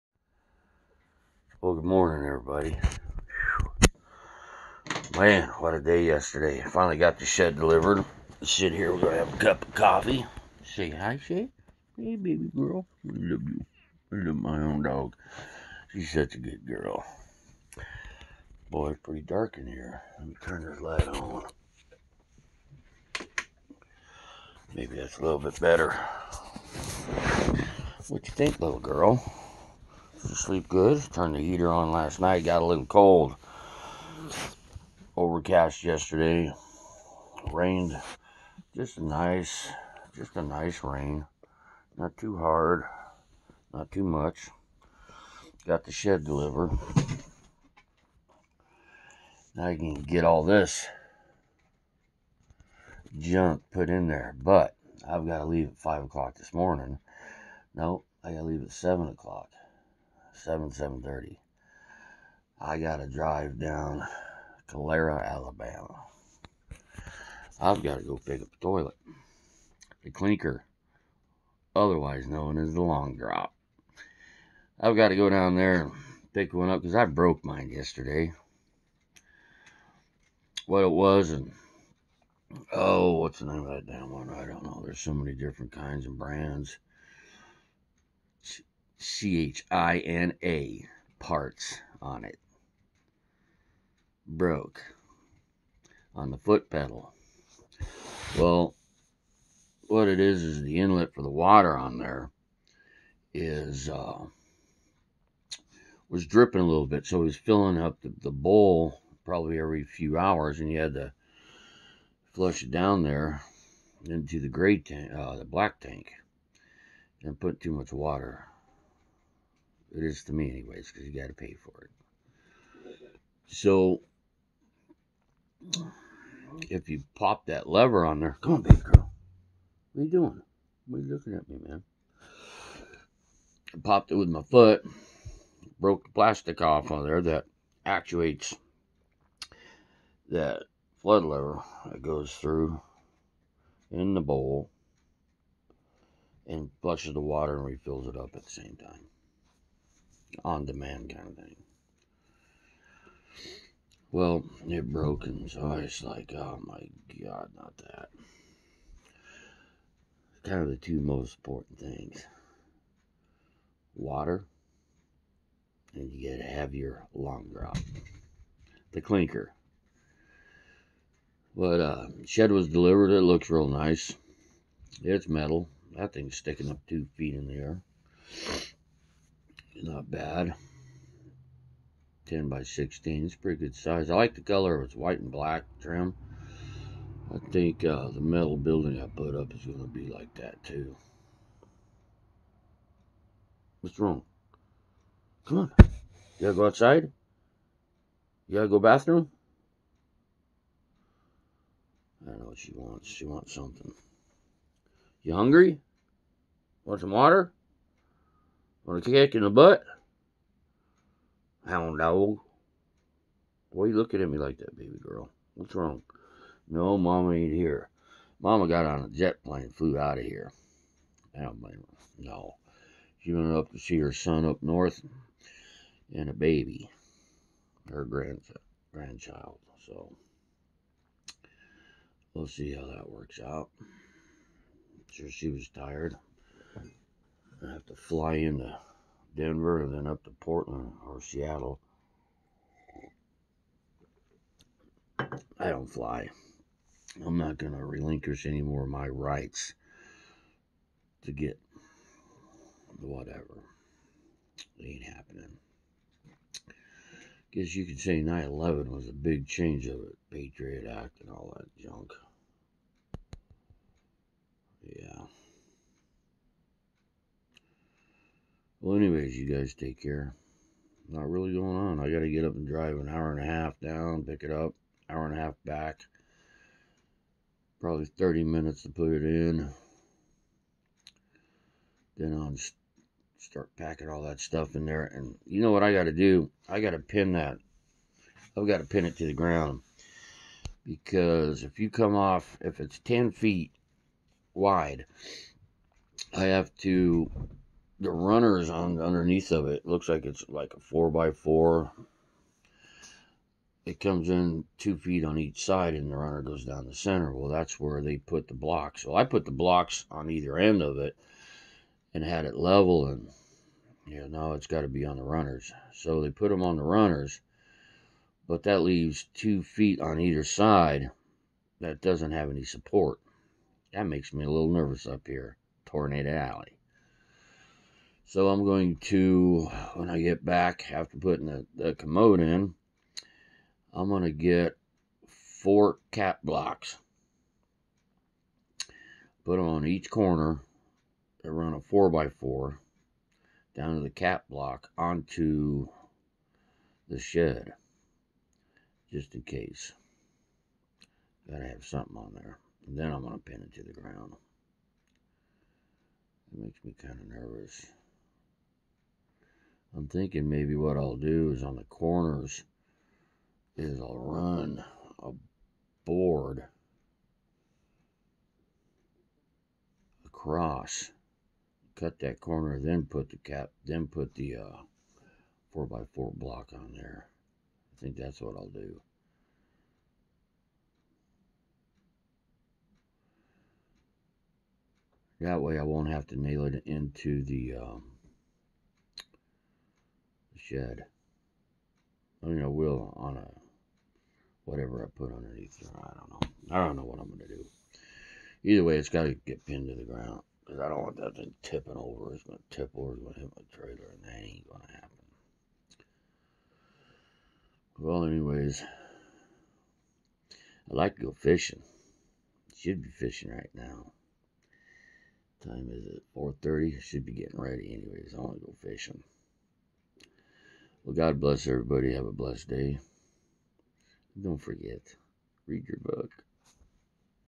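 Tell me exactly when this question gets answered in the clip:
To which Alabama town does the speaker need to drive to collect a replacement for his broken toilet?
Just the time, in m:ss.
1:04.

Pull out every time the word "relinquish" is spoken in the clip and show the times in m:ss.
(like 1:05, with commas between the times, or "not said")
4:07.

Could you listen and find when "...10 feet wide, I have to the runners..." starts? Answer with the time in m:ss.
4:52.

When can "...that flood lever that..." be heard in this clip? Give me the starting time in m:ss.
2:20.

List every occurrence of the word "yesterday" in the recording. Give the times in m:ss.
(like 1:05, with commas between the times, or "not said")
0:06, 0:35, 1:17.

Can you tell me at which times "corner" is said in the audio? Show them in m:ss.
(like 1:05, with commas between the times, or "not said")
5:40, 6:01, 6:12.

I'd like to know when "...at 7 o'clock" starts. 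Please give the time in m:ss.
0:58.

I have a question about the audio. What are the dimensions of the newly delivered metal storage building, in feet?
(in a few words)
10 by 16.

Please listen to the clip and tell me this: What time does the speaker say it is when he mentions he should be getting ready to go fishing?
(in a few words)
4:30.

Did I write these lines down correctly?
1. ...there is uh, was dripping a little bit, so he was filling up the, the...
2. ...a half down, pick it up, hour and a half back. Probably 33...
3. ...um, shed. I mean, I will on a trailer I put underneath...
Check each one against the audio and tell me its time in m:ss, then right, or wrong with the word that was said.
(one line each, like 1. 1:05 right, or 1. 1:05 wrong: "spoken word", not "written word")
1. 1:41 right
2. 4:33 wrong: "30", not "33"
3. 6:27 wrong: "whatever", not "trailer".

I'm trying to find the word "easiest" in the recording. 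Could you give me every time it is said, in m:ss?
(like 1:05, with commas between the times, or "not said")
not said.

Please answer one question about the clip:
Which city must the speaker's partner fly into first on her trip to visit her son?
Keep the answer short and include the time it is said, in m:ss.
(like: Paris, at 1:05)
Denver, at 3:59.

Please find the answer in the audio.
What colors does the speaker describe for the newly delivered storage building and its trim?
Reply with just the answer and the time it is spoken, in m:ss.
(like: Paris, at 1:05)
white and black, at 3:04.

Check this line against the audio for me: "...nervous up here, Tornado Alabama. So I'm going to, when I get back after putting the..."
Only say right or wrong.
wrong.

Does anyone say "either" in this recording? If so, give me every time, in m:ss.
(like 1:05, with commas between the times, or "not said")
5:10, 5:20, 6:38.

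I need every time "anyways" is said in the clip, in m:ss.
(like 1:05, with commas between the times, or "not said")
2:00, 4:28, 6:48, 6:57.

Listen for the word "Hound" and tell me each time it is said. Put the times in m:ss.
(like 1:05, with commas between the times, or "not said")
3:31.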